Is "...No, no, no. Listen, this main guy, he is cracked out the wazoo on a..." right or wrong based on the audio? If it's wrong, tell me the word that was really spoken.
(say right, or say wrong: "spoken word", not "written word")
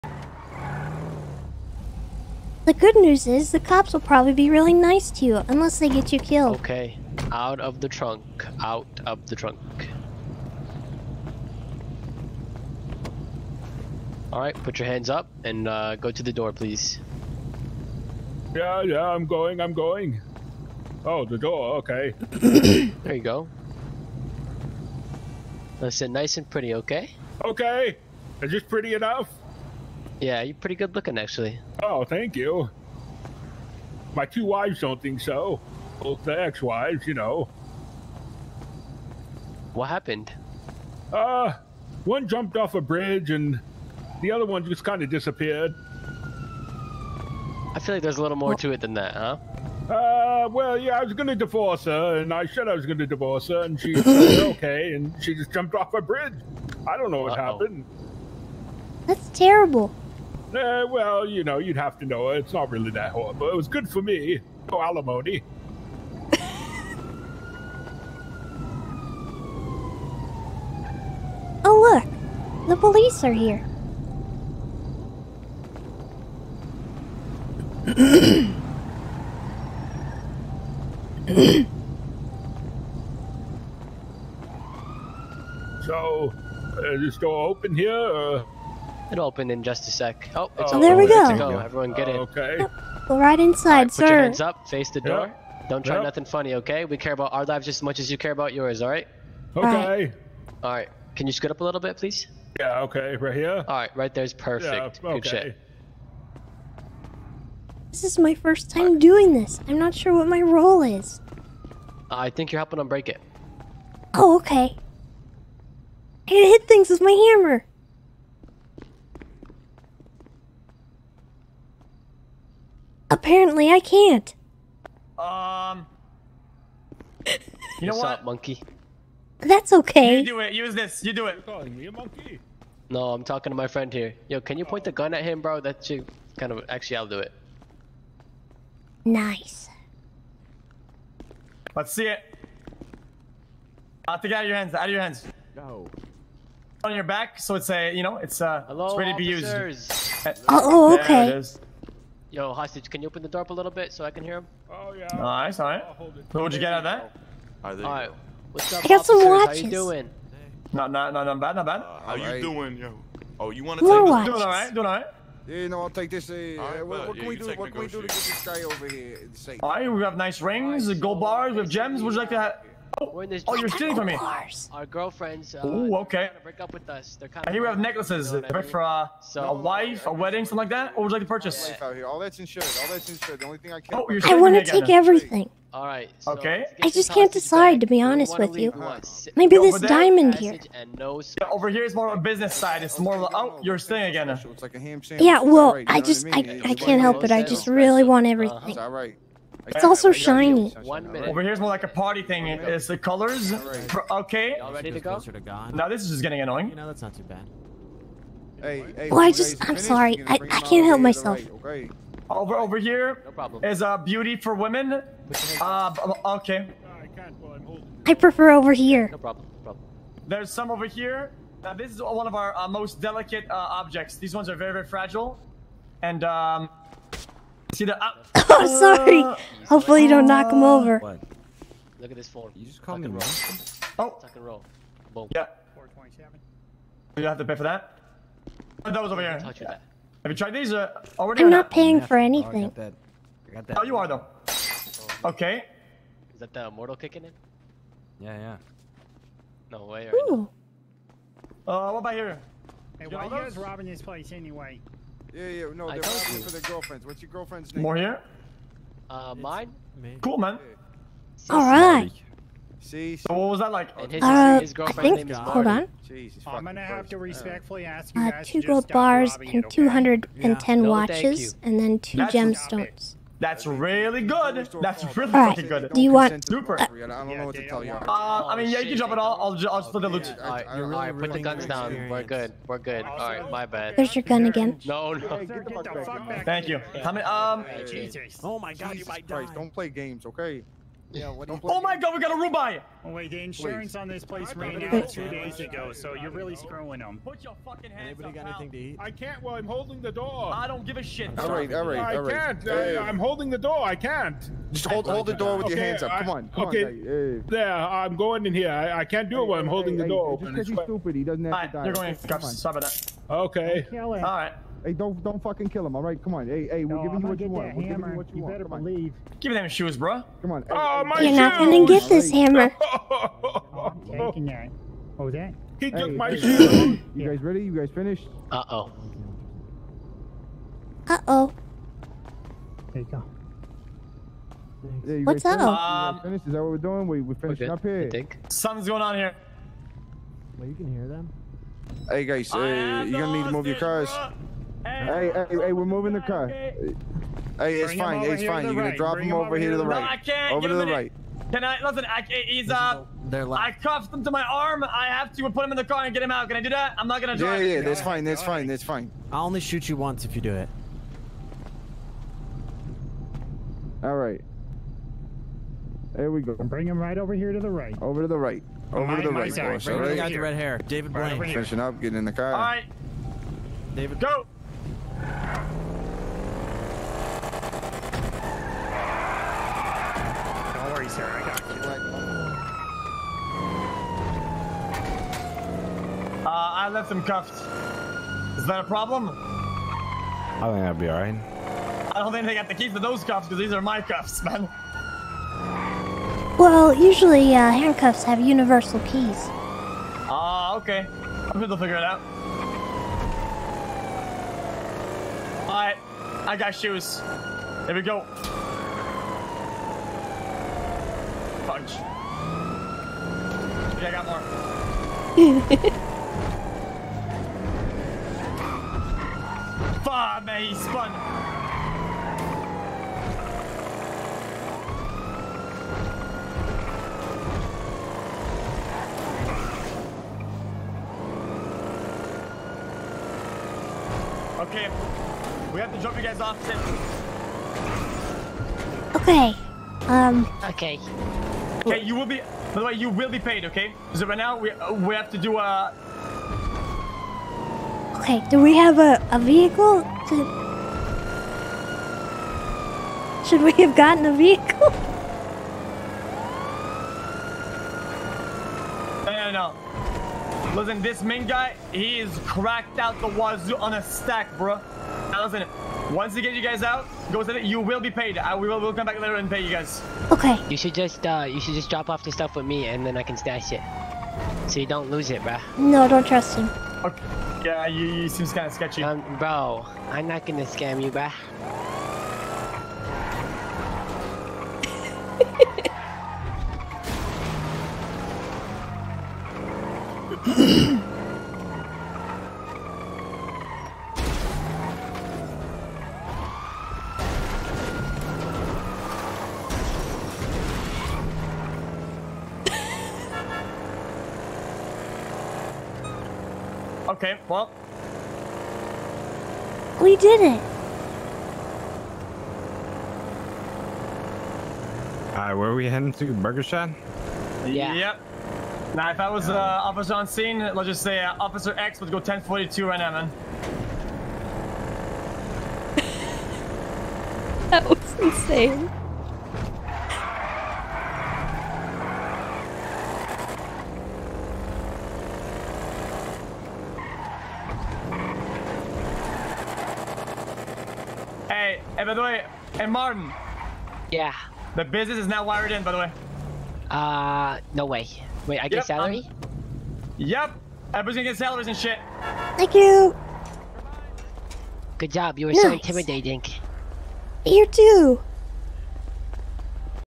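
right.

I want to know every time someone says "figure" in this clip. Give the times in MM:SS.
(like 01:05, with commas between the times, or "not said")
06:41.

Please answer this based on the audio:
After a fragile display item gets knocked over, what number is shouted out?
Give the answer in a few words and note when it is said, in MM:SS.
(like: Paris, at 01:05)
427, at 03:55.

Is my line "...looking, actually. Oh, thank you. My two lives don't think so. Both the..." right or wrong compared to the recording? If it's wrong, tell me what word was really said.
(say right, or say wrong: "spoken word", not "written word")
wrong: "wives", not "lives".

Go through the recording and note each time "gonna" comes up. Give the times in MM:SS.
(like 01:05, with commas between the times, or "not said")
04:26, 05:21, 05:43, 05:48, 05:57, 08:00, 09:11.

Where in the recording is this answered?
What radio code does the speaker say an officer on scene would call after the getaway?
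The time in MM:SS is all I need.
08:42.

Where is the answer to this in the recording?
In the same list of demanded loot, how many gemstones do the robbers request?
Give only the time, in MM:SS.
04:31.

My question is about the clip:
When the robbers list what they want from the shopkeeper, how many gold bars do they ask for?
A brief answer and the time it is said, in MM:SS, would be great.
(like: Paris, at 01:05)
2, at 04:28.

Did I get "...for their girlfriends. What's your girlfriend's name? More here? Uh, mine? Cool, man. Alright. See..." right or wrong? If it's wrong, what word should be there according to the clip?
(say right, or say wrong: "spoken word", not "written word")
right.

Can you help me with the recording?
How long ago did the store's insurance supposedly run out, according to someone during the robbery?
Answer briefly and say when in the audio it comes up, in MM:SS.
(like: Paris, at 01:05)
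2 days, at 04:55.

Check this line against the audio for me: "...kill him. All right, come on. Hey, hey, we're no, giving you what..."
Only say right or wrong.
right.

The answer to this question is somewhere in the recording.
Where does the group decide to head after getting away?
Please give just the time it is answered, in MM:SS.
08:36.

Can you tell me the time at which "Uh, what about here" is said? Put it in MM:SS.
04:11.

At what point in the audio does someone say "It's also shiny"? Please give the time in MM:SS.
03:19.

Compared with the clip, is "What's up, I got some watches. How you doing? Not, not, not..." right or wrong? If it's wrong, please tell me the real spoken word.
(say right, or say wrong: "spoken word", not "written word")
right.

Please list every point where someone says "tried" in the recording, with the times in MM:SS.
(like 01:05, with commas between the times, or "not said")
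04:00.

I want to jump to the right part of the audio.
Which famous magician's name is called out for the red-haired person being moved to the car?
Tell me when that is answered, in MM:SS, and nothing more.
06:10.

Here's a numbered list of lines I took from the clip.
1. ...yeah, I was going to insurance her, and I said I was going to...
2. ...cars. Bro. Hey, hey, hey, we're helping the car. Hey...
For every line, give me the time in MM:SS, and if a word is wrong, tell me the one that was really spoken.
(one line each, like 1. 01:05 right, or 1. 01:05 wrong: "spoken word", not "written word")
1. 00:50 wrong: "divorce", not "insurance"
2. 05:43 wrong: "moving", not "helping".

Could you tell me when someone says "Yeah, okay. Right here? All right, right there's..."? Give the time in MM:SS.
01:42.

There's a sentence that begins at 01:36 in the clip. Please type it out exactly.
We care about our lives just as much as you care about yours, all right?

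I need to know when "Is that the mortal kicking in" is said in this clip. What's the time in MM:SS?
04:06.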